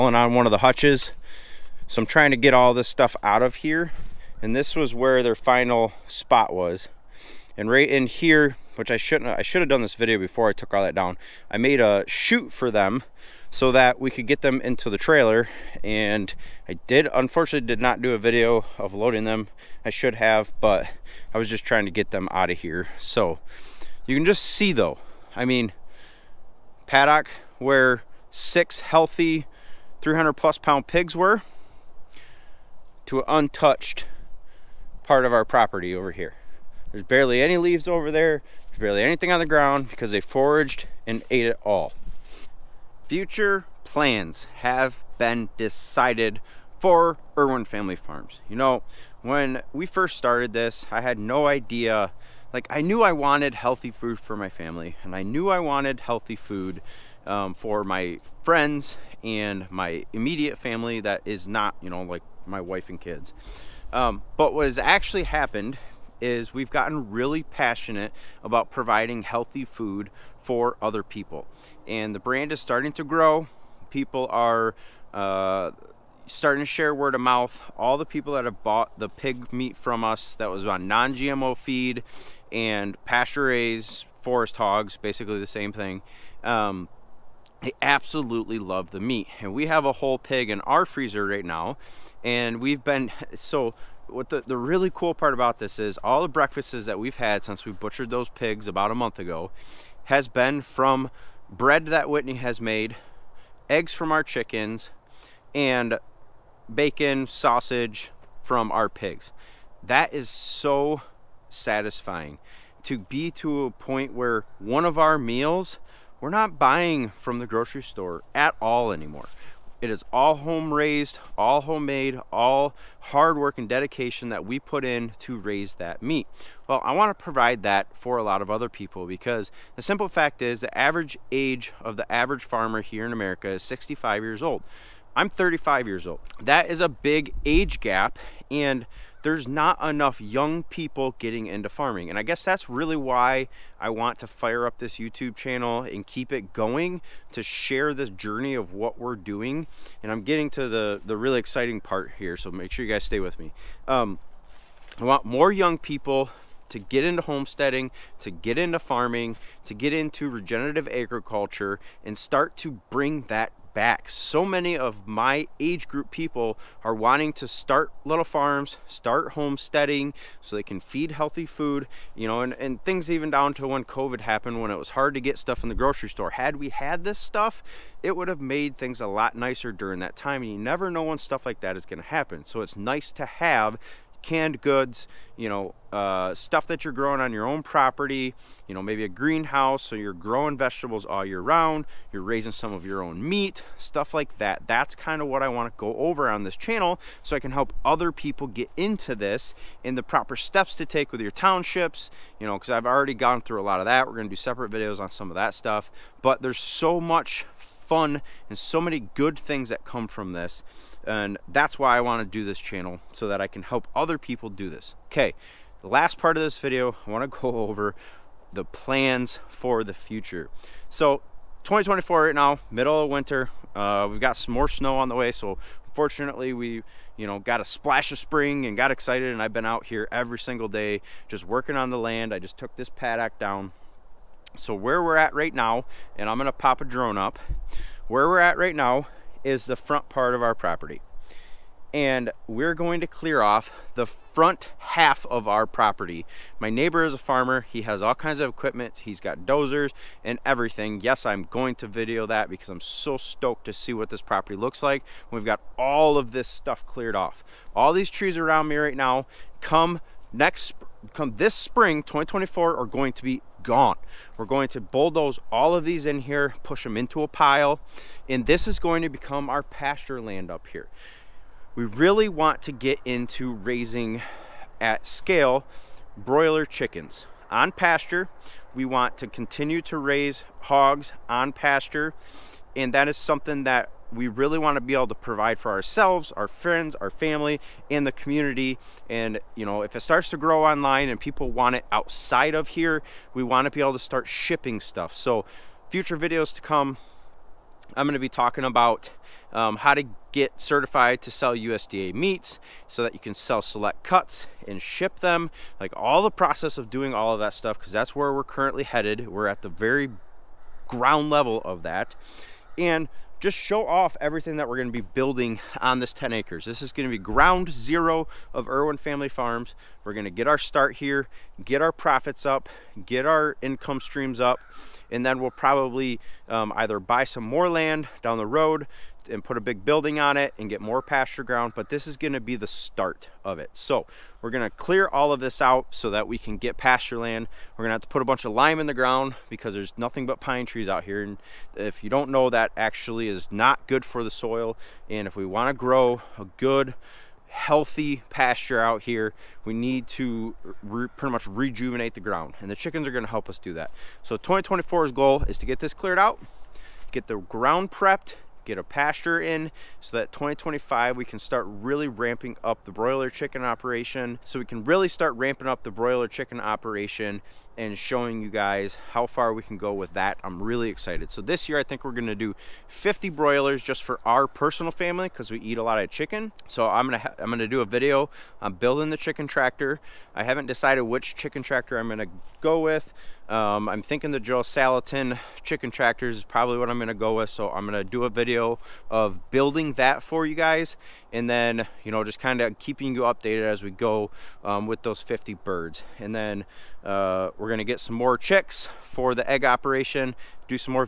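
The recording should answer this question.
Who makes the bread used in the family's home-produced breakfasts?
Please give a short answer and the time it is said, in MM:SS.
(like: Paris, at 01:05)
Whitney, at 01:42.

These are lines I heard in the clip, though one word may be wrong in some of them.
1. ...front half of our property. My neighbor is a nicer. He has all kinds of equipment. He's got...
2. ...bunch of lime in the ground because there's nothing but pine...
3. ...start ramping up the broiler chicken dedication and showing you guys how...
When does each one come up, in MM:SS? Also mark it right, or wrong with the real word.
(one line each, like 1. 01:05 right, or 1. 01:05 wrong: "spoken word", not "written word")
1. 04:04 wrong: "farmer", not "nicer"
2. 05:38 right
3. 06:05 wrong: "operation", not "dedication".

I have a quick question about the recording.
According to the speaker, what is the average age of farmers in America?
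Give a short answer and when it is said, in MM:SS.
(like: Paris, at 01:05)
65, at 02:13.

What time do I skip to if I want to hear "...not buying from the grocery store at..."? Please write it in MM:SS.
01:56.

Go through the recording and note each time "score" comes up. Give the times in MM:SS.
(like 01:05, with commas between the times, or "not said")
not said.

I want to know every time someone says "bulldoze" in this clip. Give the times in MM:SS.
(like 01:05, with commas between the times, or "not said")
04:24.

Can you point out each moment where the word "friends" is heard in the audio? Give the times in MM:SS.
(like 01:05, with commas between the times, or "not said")
00:58, 04:46.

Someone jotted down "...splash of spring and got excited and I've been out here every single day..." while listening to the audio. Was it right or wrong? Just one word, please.
right.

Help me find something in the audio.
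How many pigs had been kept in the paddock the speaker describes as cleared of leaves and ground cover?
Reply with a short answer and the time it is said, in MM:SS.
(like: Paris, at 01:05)
6, at 00:28.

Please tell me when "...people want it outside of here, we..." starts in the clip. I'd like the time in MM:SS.
04:51.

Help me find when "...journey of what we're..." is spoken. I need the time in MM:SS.
02:28.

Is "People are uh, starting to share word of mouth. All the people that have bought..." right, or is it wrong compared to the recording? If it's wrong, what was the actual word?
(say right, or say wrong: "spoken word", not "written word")
right.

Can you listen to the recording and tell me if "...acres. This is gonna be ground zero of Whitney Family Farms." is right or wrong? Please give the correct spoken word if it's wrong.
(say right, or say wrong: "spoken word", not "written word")
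wrong: "Irwin", not "Whitney".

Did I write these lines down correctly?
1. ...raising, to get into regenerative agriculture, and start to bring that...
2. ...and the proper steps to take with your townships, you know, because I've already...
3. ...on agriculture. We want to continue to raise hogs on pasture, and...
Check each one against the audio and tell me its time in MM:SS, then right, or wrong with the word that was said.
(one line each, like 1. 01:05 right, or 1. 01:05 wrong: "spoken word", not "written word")
1. 02:38 wrong: "farming", not "raising"
2. 03:19 right
3. 04:37 wrong: "pasture", not "agriculture".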